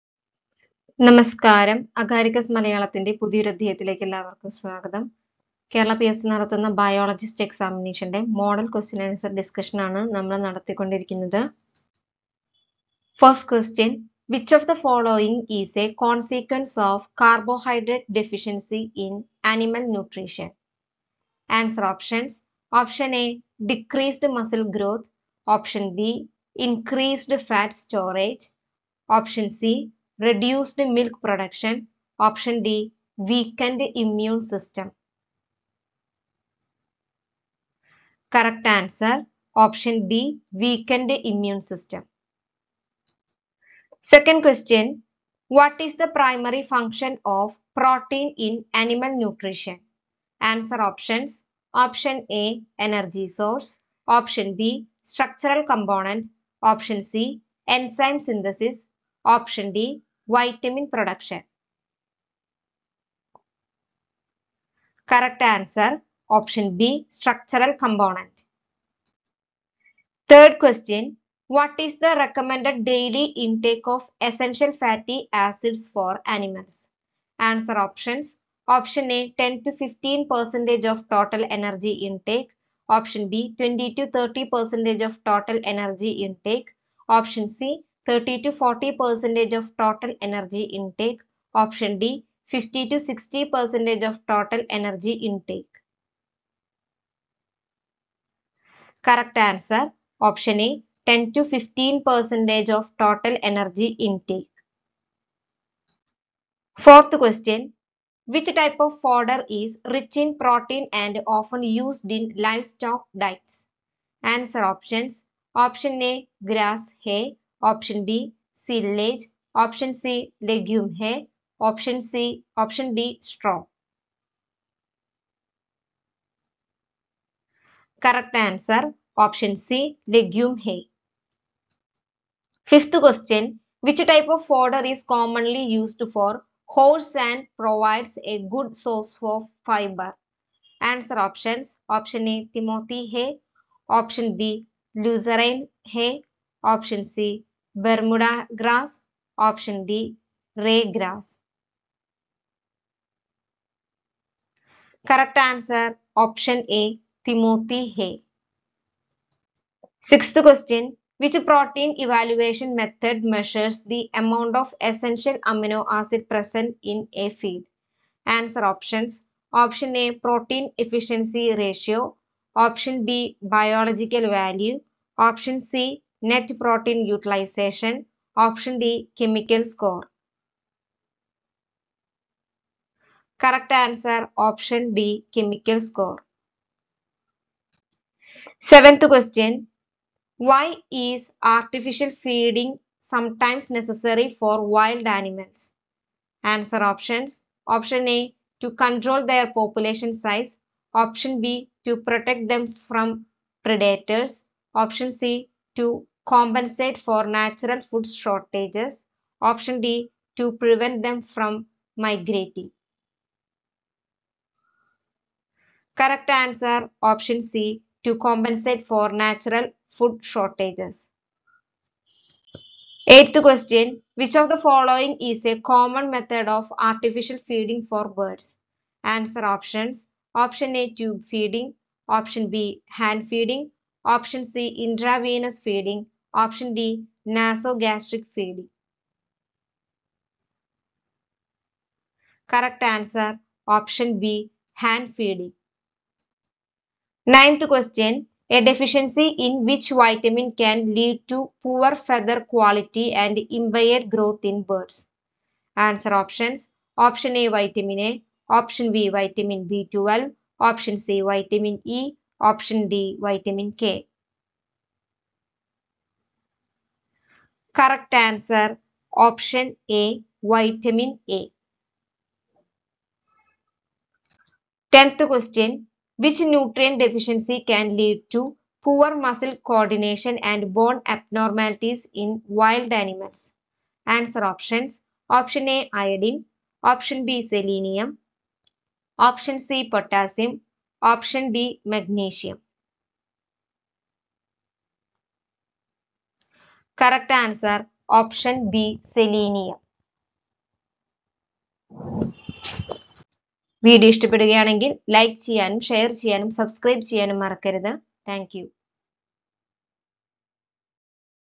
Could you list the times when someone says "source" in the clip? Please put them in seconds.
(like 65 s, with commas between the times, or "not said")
53 s, 138 s.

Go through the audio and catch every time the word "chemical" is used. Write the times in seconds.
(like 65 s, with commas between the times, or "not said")
179 s, 185 s.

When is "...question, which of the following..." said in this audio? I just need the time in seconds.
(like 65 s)
223 s.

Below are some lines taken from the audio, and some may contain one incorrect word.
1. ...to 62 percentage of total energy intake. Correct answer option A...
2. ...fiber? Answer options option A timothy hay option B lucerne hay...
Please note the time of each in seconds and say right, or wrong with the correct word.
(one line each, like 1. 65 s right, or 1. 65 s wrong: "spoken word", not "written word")
1. 92 s wrong: "60", not "62"
2. 139 s right.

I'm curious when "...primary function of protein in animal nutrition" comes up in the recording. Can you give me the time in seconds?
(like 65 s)
46 s.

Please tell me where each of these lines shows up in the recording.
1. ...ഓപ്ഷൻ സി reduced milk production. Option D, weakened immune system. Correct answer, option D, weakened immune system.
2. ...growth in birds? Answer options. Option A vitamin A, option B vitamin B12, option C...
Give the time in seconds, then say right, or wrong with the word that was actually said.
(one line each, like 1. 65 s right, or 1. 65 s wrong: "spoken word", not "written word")
1. 29 s right
2. 254 s right.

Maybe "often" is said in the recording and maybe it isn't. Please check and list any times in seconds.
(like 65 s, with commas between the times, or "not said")
111 s.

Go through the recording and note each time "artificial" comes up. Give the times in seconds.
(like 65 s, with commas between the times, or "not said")
191 s, 226 s.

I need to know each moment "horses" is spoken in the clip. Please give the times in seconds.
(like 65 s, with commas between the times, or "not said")
136 s.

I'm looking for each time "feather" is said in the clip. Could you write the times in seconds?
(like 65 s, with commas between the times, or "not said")
251 s.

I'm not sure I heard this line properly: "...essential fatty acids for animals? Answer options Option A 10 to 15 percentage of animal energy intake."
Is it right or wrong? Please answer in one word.
wrong.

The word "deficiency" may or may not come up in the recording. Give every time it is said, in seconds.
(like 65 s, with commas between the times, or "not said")
248 s, 276 s.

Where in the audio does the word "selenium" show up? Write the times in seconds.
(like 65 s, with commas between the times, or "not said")
287 s.